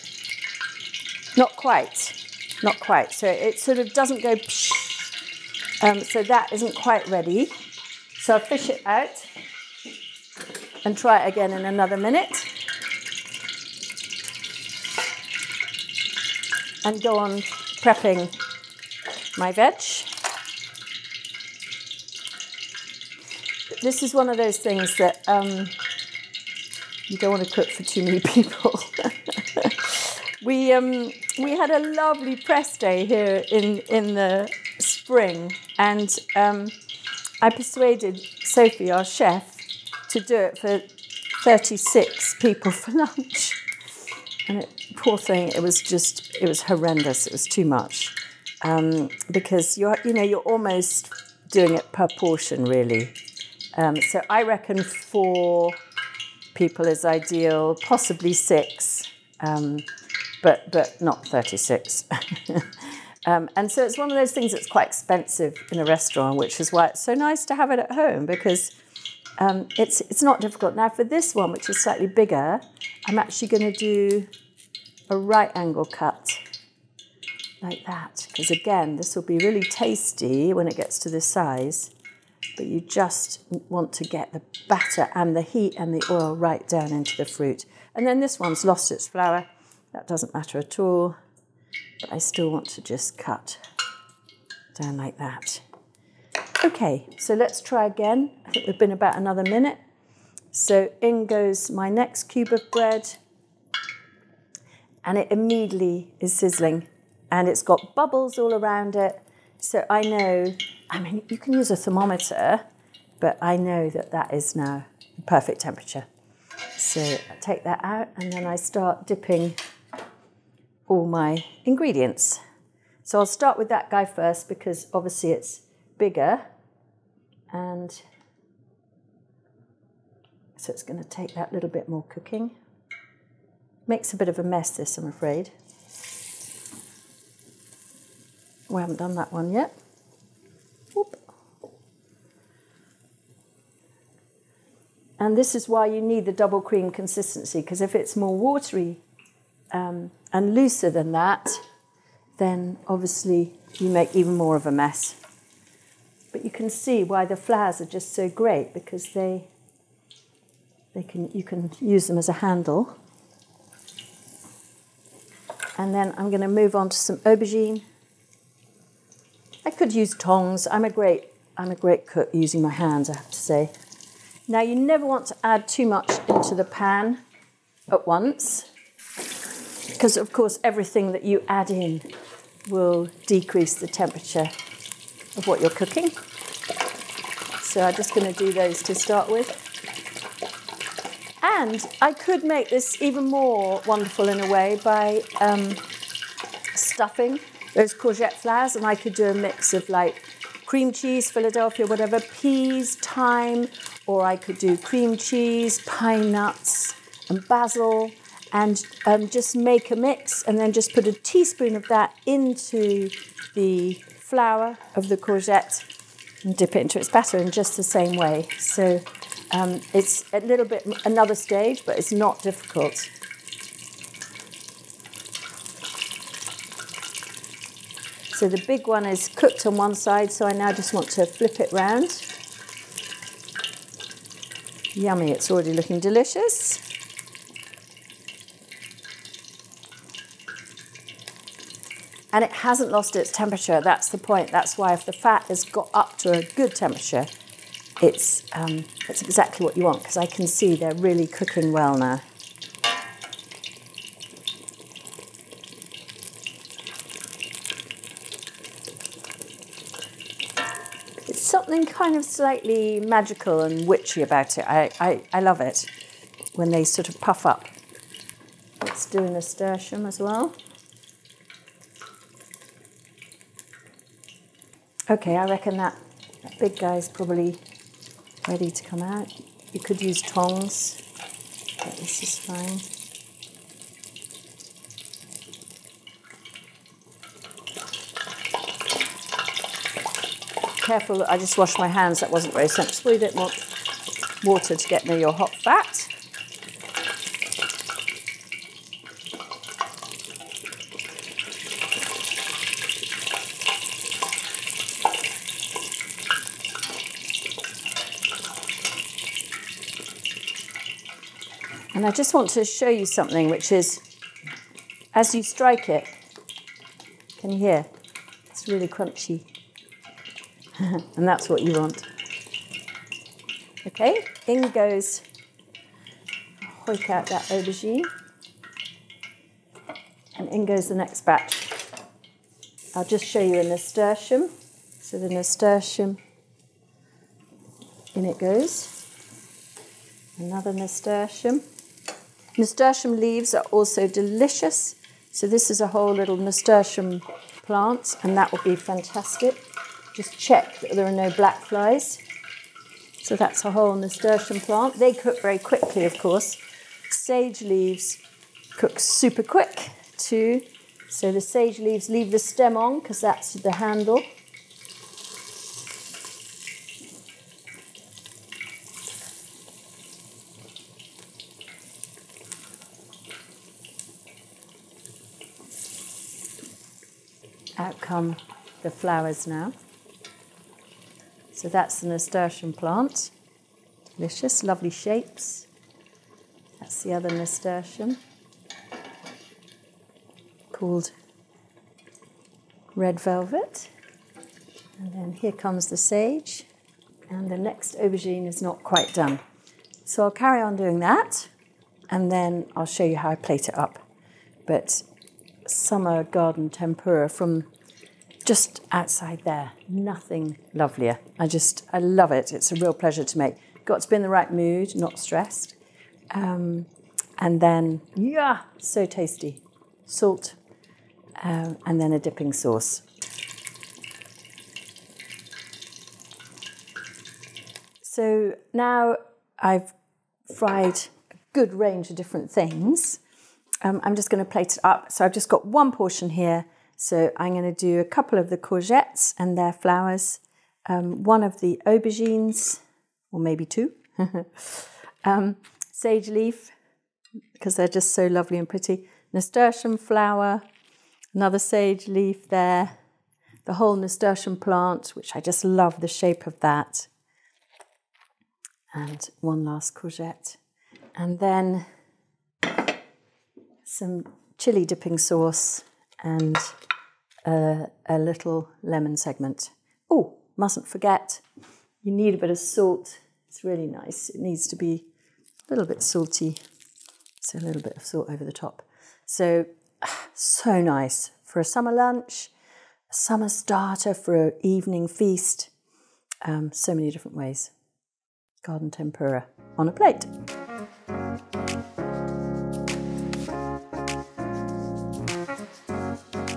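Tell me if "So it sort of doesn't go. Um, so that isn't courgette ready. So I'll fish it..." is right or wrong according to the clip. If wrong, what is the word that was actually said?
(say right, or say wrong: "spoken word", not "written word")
wrong: "quite", not "courgette".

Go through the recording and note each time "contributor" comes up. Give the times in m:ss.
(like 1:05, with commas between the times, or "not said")
not said.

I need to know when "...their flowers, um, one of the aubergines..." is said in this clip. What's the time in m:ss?
7:19.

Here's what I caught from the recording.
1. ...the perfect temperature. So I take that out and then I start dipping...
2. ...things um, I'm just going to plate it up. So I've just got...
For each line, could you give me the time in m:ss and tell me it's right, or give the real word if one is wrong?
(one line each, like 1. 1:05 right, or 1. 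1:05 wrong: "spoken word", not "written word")
1. 1:55 right
2. 7:12 right.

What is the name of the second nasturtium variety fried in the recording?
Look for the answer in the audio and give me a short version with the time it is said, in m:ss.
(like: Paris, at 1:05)
red velvet, at 6:32.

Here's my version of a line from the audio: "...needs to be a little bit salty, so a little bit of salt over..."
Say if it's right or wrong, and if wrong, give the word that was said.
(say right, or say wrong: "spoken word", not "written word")
right.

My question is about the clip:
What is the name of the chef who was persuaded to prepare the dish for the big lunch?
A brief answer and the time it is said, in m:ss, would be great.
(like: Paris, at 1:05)
Sophie, at 0:38.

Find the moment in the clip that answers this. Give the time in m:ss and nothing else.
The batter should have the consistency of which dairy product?
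2:26.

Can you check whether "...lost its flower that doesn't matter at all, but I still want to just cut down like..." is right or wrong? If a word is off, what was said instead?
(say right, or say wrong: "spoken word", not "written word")
right.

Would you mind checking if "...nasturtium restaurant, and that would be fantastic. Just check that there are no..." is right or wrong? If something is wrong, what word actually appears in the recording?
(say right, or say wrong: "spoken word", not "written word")
wrong: "plant", not "restaurant".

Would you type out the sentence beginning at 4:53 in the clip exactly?
We don't want water to get near your hot fat.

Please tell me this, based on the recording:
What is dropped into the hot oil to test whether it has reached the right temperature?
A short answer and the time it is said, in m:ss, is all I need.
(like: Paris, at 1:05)
cube of bread, at 1:42.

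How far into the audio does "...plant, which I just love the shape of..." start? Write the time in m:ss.
7:34.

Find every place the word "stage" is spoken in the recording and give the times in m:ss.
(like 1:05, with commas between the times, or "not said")
3:41.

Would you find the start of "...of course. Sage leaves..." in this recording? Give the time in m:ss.
5:56.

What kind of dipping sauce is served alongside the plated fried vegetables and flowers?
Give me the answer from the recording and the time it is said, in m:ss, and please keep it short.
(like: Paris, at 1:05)
chili dipping sauce, at 7:44.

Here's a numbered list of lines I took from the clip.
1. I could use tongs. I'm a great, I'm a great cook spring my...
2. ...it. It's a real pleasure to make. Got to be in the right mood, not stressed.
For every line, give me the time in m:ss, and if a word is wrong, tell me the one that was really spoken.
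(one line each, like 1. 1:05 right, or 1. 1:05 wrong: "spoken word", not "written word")
1. 2:49 wrong: "using", not "spring"
2. 6:52 right.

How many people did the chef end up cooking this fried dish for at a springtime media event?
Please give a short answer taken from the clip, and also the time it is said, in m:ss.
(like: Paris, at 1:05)
36, at 0:41.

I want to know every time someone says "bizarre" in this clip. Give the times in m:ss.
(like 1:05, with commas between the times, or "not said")
not said.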